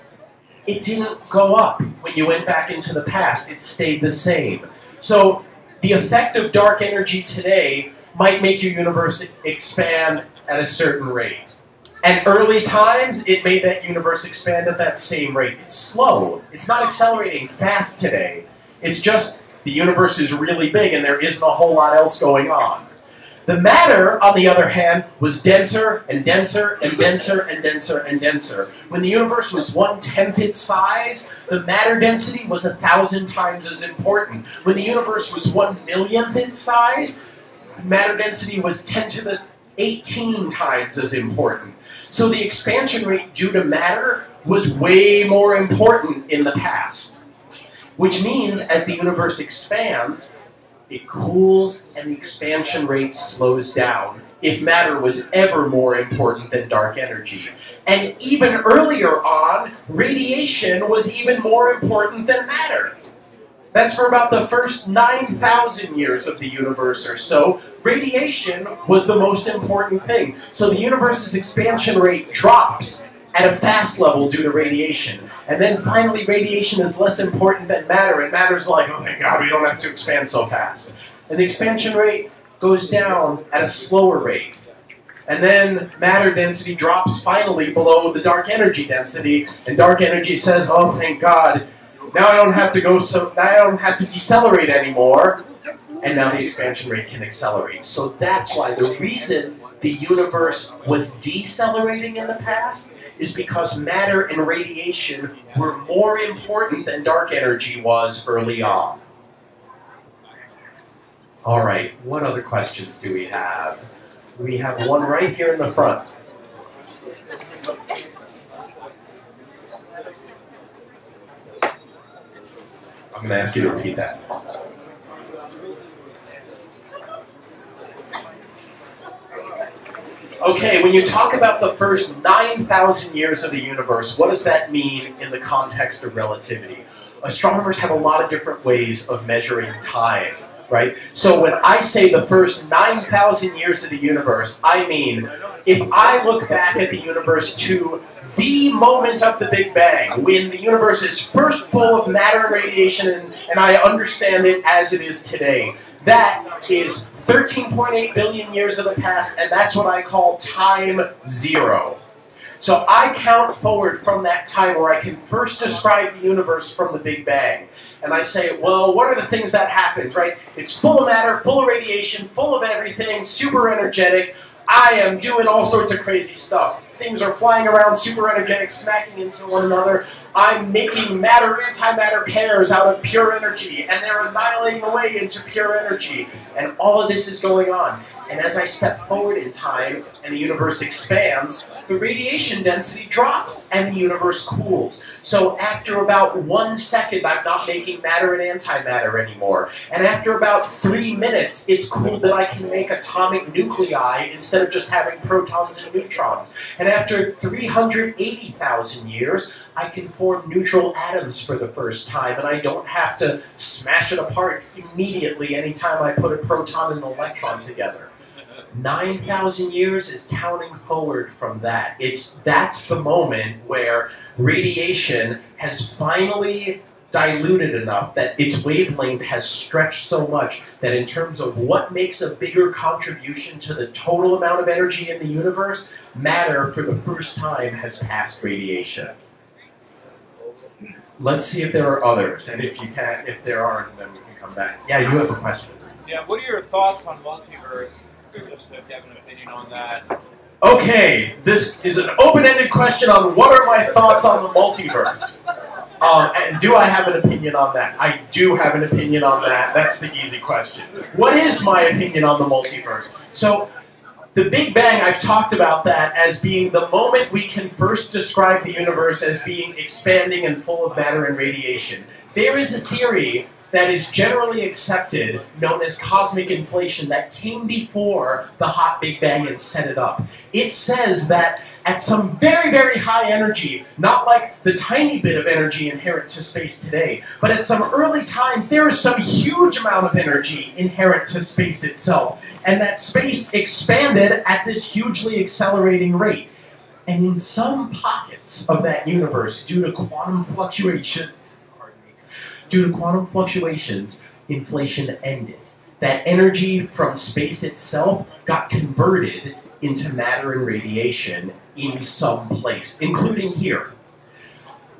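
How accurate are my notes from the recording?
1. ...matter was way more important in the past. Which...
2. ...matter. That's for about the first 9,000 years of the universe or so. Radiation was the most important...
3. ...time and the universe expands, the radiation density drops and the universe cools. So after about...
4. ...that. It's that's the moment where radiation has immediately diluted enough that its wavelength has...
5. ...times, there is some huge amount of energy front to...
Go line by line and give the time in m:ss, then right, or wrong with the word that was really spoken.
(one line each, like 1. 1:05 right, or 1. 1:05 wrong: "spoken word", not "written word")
1. 0:43 right
2. 1:02 right
3. 3:09 right
4. 3:41 wrong: "finally", not "immediately"
5. 4:48 wrong: "inherent", not "front".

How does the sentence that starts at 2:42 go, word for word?
So I count forward from that time where I can first describe the universe from the Big Bang.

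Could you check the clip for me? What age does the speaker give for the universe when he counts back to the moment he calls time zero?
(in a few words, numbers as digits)
13.8 billion years.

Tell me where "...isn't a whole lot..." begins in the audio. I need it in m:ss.
0:21.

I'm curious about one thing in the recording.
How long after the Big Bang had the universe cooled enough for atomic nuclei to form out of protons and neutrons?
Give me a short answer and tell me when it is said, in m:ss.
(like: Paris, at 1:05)
3 minutes, at 3:20.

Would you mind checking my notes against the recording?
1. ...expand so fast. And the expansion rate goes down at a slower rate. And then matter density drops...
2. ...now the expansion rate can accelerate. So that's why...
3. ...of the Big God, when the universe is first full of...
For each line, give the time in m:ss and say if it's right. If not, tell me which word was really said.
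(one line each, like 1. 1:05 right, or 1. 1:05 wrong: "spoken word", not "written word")
1. 1:19 right
2. 1:36 right
3. 2:29 wrong: "Bang", not "God".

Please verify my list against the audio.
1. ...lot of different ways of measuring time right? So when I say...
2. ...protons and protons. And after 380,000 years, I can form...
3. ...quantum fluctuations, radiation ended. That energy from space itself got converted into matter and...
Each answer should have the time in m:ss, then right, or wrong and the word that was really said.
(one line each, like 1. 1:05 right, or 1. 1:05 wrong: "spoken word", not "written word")
1. 2:17 right
2. 3:25 wrong: "neutrons", not "protons"
3. 5:02 wrong: "inflation", not "radiation".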